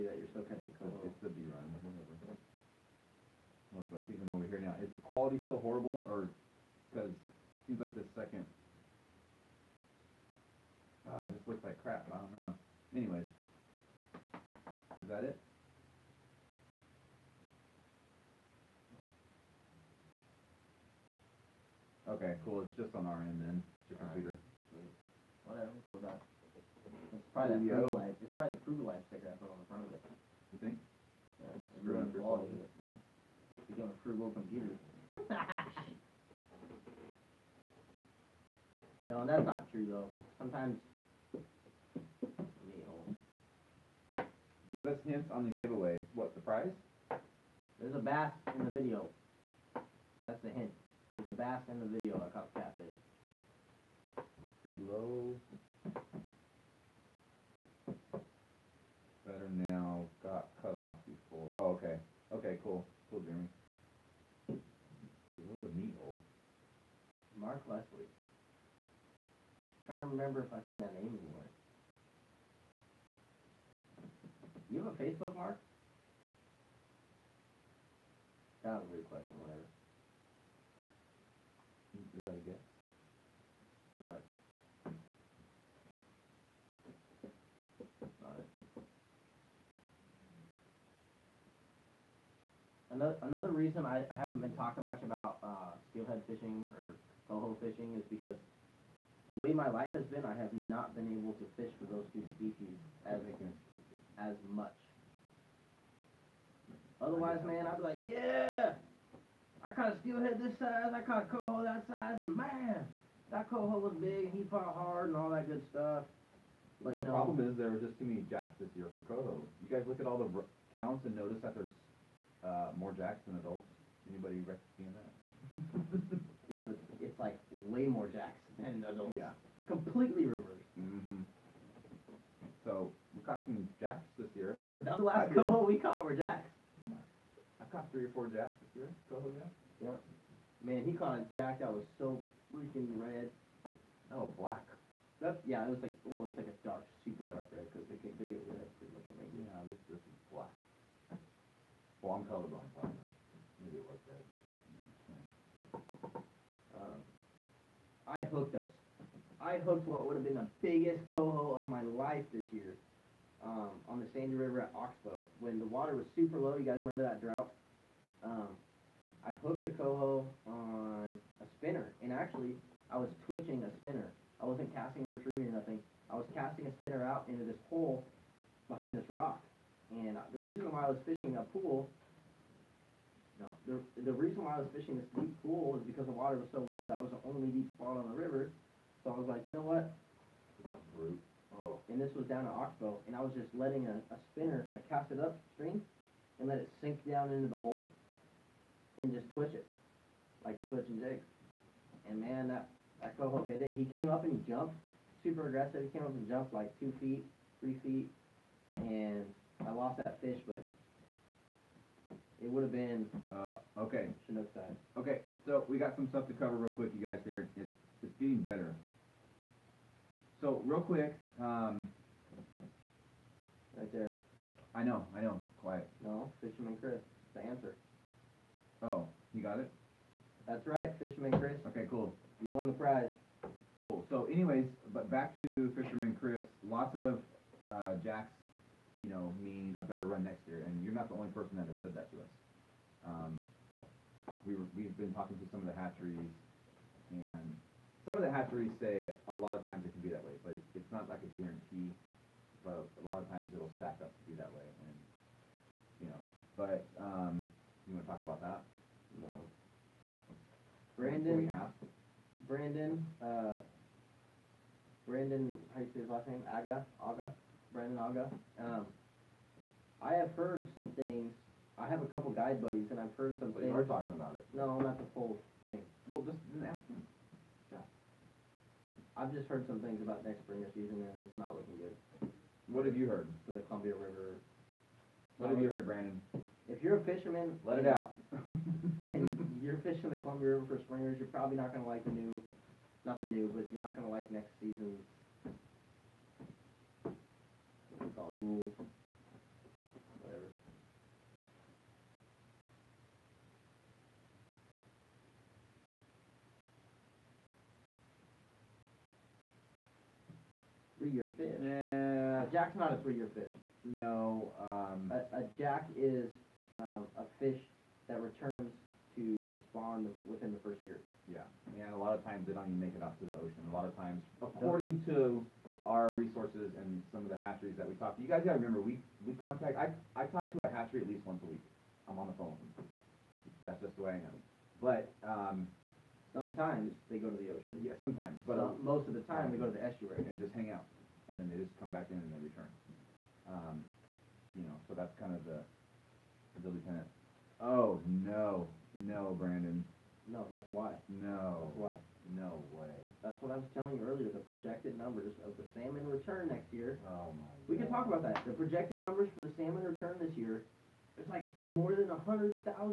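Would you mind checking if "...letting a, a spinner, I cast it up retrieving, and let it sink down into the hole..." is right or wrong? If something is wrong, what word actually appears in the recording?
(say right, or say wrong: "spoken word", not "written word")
wrong: "string", not "retrieving".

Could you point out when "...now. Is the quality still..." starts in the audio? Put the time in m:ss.
0:04.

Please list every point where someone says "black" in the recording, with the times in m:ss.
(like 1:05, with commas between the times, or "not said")
2:24, 2:30.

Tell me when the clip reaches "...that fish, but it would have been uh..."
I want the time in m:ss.
3:30.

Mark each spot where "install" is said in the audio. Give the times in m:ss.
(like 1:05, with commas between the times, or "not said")
not said.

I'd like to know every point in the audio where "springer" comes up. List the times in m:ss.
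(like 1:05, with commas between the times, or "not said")
4:40, 4:50.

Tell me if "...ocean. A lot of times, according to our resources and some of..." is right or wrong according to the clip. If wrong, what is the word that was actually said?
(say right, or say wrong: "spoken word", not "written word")
right.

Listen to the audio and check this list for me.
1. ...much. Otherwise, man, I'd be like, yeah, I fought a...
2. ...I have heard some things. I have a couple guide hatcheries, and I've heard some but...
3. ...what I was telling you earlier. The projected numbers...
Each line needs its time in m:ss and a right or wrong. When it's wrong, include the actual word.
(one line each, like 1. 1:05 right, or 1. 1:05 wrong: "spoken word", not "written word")
1. 1:44 wrong: "caught", not "fought"
2. 4:30 wrong: "buddies", not "hatcheries"
3. 5:53 right.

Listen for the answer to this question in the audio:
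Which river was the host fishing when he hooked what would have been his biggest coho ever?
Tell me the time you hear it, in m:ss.
2:44.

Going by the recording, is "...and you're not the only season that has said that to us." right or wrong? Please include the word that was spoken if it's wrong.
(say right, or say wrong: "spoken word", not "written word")
wrong: "person", not "season".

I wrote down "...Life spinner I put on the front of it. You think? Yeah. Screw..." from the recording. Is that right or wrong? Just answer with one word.
wrong.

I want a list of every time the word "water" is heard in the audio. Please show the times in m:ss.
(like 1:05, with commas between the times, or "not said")
2:45, 3:06.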